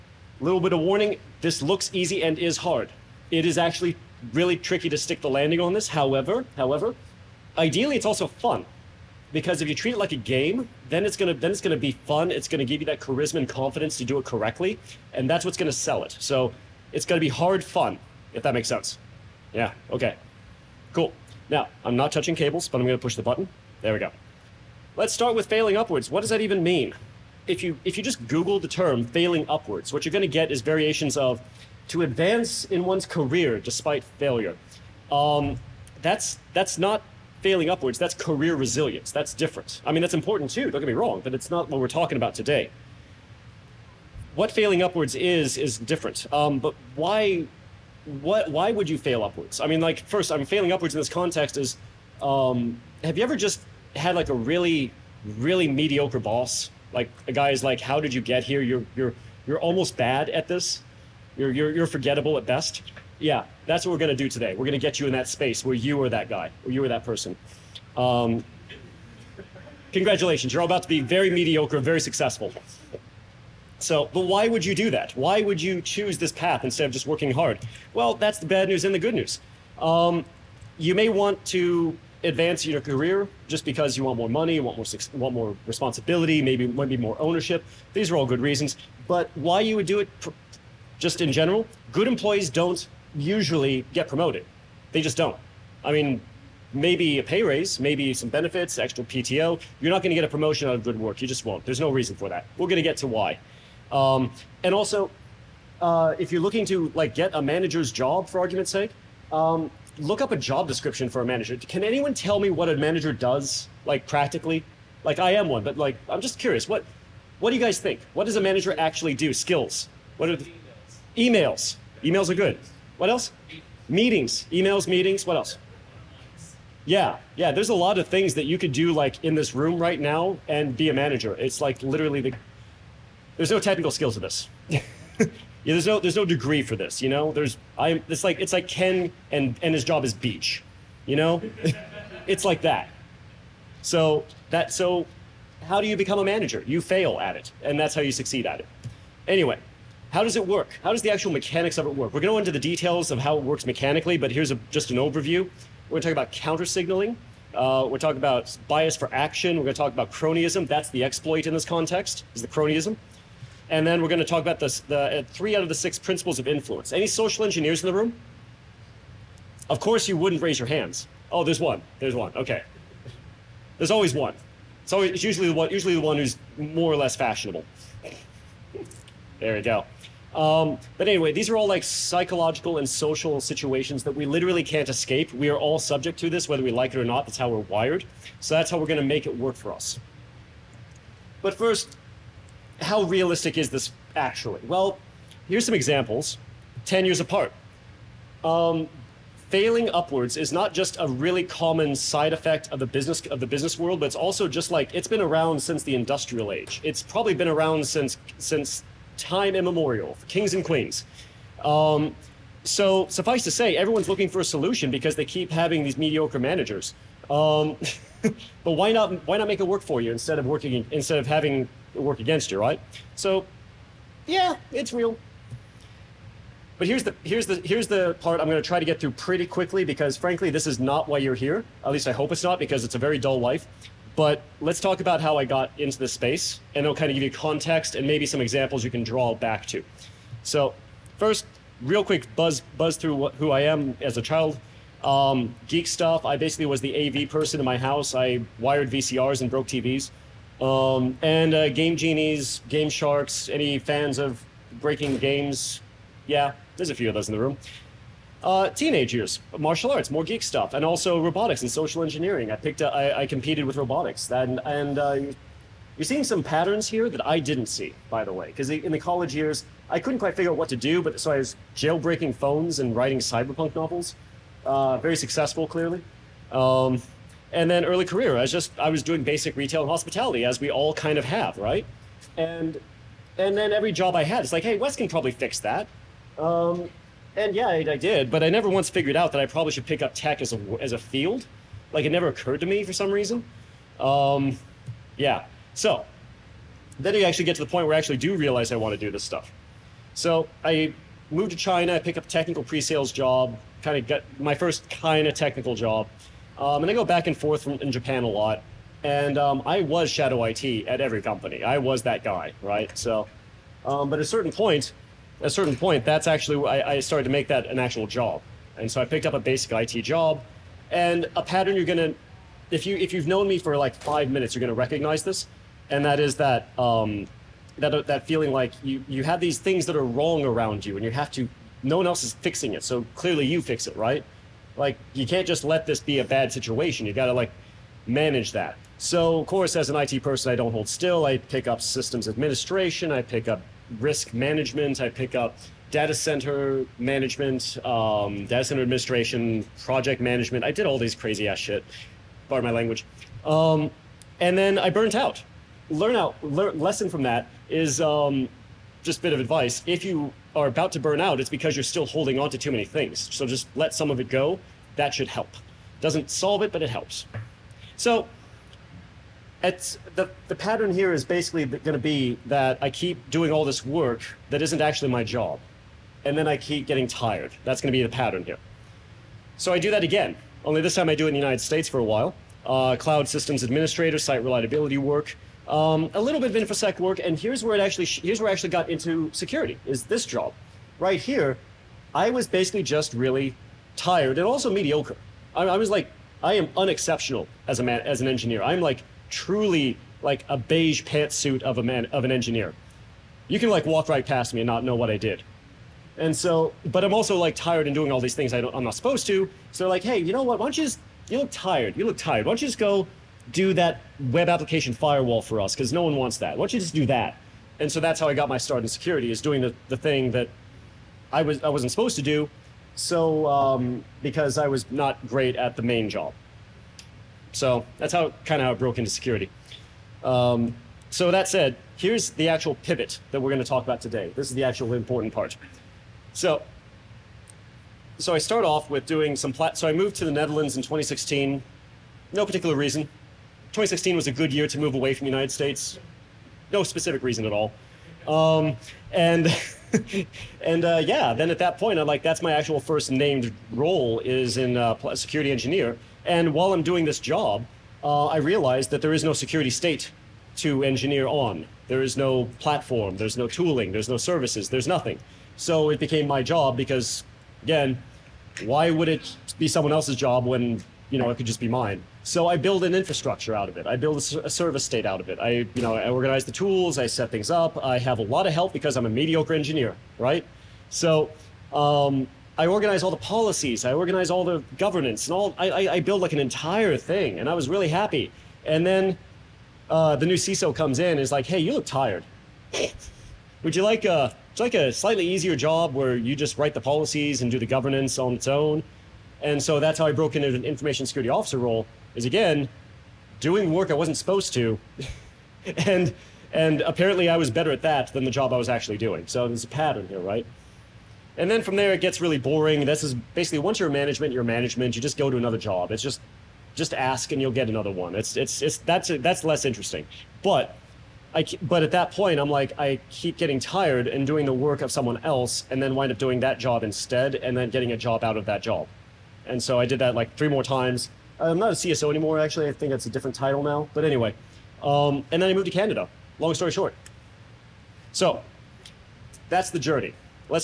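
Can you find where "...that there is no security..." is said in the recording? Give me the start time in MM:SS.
07:38.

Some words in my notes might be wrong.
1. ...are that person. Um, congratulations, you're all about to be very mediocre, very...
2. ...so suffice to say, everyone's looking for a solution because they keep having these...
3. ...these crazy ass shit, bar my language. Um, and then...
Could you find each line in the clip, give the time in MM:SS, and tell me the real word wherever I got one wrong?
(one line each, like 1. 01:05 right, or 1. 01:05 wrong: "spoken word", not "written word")
1. 01:06 right
2. 03:32 right
3. 05:50 right.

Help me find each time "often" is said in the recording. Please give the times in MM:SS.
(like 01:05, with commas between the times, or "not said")
not said.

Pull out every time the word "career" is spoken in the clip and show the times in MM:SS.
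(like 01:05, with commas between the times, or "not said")
00:33, 00:38, 01:22, 04:38.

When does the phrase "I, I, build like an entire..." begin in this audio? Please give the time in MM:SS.
08:05.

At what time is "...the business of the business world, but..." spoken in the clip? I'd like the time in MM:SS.
03:22.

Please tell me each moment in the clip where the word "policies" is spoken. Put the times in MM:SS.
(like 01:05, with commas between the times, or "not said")
08:03, 08:16.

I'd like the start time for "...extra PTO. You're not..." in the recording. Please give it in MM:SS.
01:38.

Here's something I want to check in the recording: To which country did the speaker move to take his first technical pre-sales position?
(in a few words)
China.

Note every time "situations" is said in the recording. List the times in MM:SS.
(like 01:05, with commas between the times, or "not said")
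03:03, 05:36.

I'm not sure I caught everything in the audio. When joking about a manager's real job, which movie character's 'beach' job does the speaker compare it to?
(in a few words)
Ken.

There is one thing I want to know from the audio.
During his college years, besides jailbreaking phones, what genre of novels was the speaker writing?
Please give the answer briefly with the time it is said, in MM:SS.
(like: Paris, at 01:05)
cyberpunk, at 04:33.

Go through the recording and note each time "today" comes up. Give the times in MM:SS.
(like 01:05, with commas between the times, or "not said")
00:42, 01:04, 07:14.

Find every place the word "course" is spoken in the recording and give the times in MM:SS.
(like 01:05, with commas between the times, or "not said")
02:49, 05:39.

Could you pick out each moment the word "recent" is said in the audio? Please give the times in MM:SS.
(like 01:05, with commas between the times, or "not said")
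not said.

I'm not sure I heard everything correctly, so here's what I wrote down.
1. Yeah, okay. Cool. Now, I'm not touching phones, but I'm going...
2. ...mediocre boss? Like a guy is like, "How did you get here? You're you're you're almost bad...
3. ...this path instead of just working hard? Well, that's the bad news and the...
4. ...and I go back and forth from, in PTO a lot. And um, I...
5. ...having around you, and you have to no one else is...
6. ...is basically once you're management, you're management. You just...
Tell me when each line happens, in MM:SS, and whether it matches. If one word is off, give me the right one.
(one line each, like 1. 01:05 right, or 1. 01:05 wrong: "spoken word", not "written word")
1. 00:19 wrong: "cables", not "phones"
2. 00:55 right
3. 01:16 right
4. 05:06 wrong: "Japan", not "PTO"
5. 05:30 wrong: "wrong", not "having"
6. 08:33 right.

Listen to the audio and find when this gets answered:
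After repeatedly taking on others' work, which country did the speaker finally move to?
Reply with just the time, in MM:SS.
08:55.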